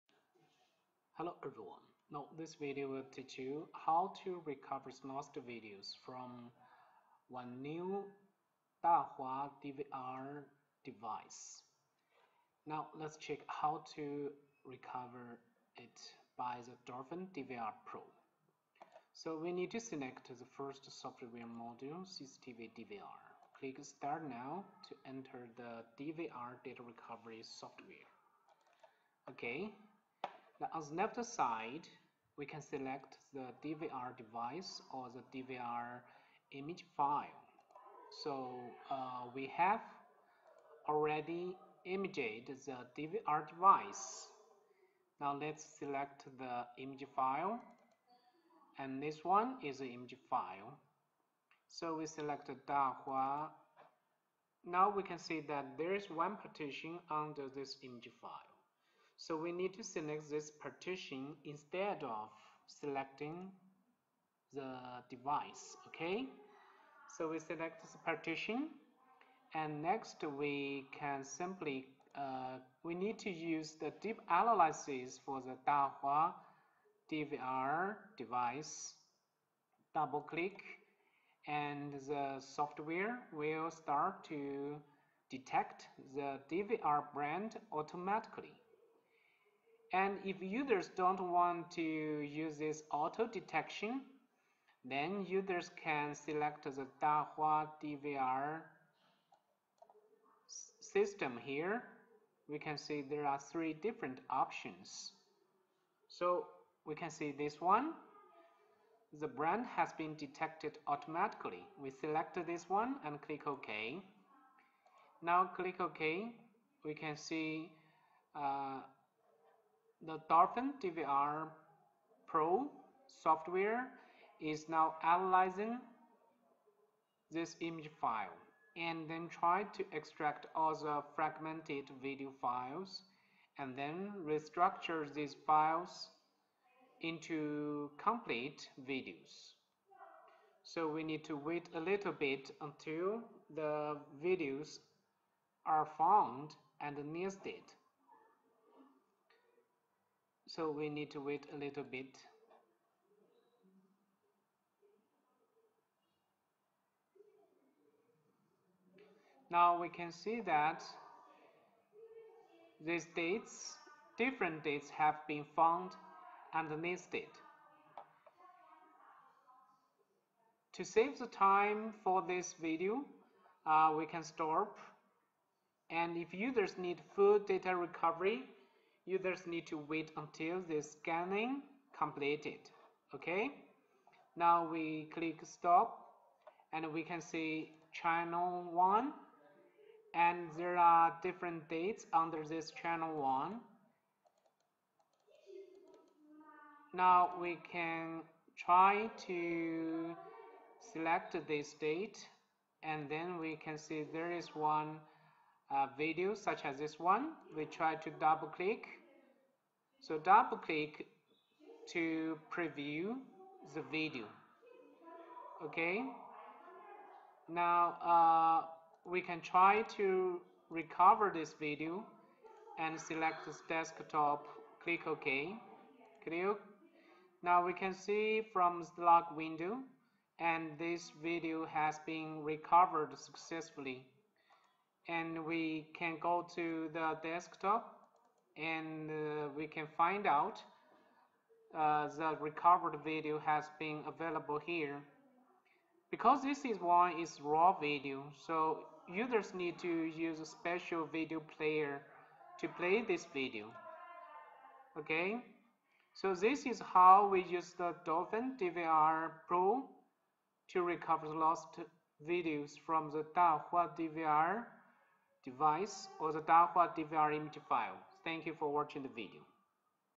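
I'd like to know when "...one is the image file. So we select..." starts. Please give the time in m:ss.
0:49.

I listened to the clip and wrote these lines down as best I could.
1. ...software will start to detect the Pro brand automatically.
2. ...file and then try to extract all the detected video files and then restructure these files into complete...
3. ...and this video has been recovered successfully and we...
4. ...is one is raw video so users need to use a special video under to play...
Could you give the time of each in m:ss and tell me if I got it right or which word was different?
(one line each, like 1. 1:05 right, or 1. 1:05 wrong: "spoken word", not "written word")
1. 1:22 wrong: "DVR", not "Pro"
2. 2:08 wrong: "fragmented", not "detected"
3. 3:50 right
4. 4:06 wrong: "player", not "under".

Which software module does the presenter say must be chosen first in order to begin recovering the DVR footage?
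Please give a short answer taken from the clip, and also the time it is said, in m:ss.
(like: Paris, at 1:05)
CCTV DVR, at 0:22.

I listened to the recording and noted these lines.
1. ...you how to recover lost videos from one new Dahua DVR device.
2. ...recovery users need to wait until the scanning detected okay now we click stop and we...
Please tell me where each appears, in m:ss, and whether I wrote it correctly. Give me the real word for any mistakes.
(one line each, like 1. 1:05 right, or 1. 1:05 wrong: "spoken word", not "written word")
1. 0:03 right
2. 2:57 wrong: "completed", not "detected".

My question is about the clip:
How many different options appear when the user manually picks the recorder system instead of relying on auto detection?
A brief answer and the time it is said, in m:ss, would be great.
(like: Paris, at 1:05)
3, at 1:43.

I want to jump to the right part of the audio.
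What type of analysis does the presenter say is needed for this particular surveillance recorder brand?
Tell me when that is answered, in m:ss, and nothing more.
1:14.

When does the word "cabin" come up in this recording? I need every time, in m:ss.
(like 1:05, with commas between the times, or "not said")
not said.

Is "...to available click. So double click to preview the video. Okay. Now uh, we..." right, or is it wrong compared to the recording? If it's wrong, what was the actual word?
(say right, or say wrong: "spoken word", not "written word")
wrong: "double", not "available".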